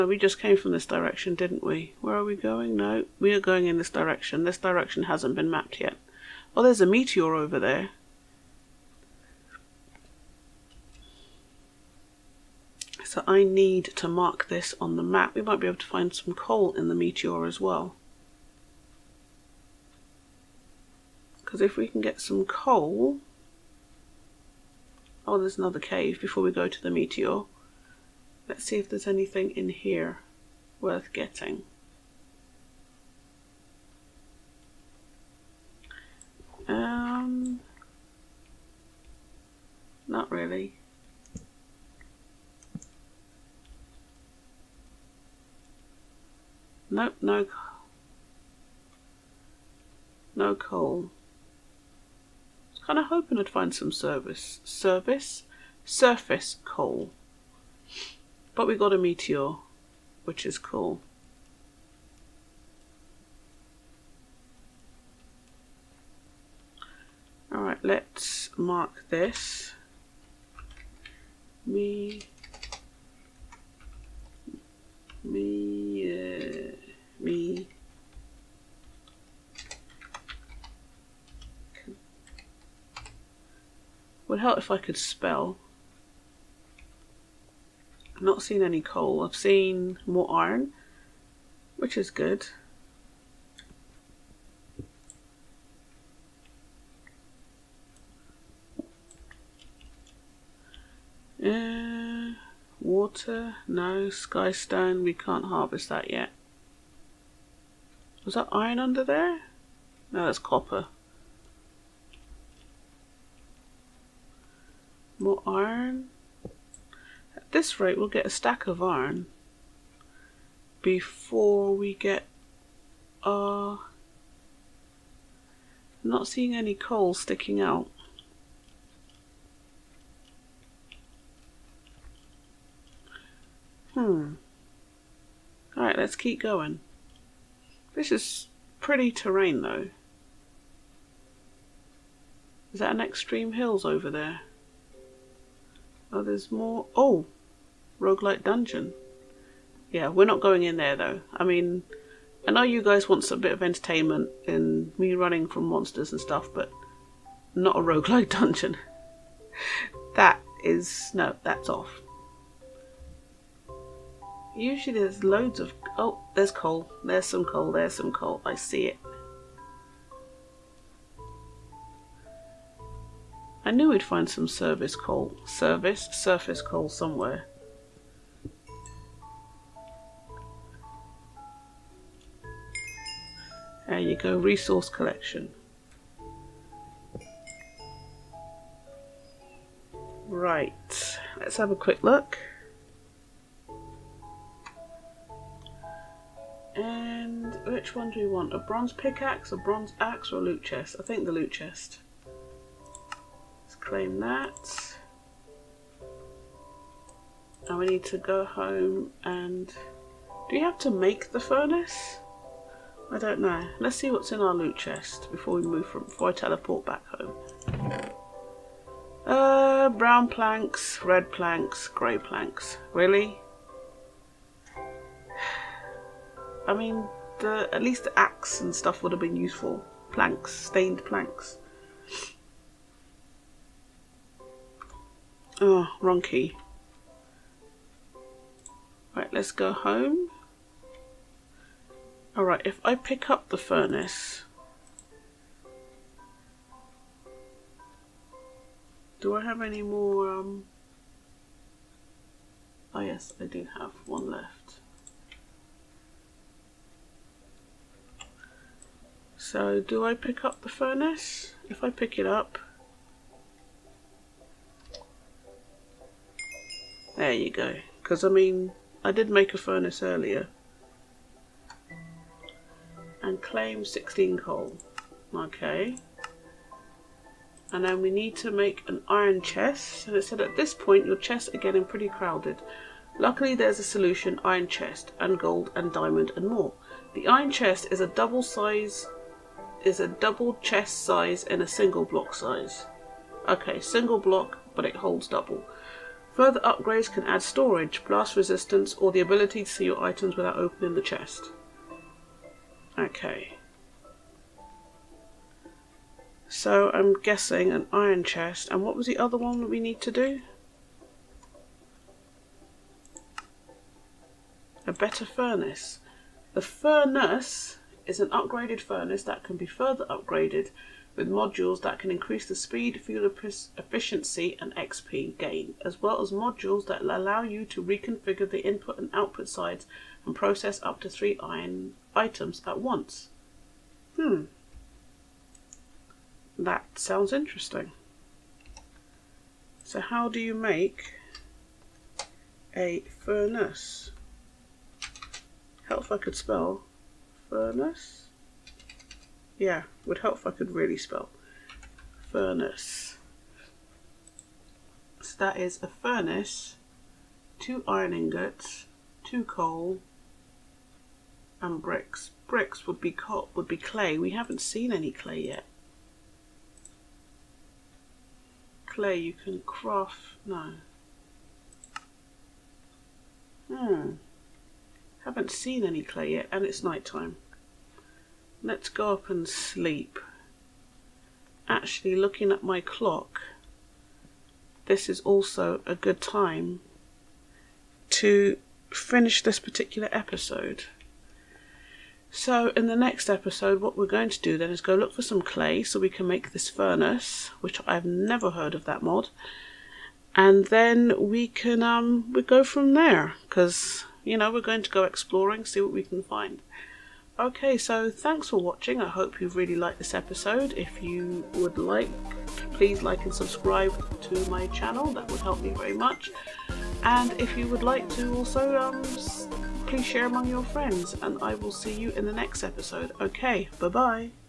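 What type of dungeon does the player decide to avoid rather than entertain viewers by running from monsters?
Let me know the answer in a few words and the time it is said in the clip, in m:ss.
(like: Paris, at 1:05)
roguelike dungeon, at 2:27.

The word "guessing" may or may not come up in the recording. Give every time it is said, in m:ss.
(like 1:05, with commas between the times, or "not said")
5:07.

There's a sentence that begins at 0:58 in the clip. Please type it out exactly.
But we got a meteor, which is cool.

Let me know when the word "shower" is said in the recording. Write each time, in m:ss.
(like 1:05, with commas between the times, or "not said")
not said.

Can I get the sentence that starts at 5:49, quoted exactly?
Yeah, would help if I could really spell Furnus.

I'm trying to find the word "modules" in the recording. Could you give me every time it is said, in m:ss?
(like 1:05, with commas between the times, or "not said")
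5:21, 5:26.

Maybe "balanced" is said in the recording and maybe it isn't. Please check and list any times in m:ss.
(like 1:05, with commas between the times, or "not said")
not said.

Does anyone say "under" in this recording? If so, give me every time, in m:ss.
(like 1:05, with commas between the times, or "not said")
1:48.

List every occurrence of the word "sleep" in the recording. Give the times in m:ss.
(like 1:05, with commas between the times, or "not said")
6:19.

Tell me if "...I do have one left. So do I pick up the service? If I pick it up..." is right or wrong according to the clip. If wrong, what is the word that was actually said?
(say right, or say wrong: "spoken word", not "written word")
wrong: "furnace", not "service".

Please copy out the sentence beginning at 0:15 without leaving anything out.
We might be able to find some coal in the meteor as well.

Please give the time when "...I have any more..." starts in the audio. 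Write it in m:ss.
4:09.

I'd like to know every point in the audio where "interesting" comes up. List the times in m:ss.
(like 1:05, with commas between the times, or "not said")
5:37.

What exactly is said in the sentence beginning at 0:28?
Let's see if there's anything in here worth getting.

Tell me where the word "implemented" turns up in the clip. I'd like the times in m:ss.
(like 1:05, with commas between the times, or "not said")
not said.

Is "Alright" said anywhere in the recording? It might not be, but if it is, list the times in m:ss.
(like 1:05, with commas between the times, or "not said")
1:07, 2:15, 4:02.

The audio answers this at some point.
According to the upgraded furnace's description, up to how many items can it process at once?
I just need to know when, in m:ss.
5:31.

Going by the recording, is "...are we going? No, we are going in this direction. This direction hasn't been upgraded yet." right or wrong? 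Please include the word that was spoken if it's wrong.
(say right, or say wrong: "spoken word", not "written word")
wrong: "mapped", not "upgraded".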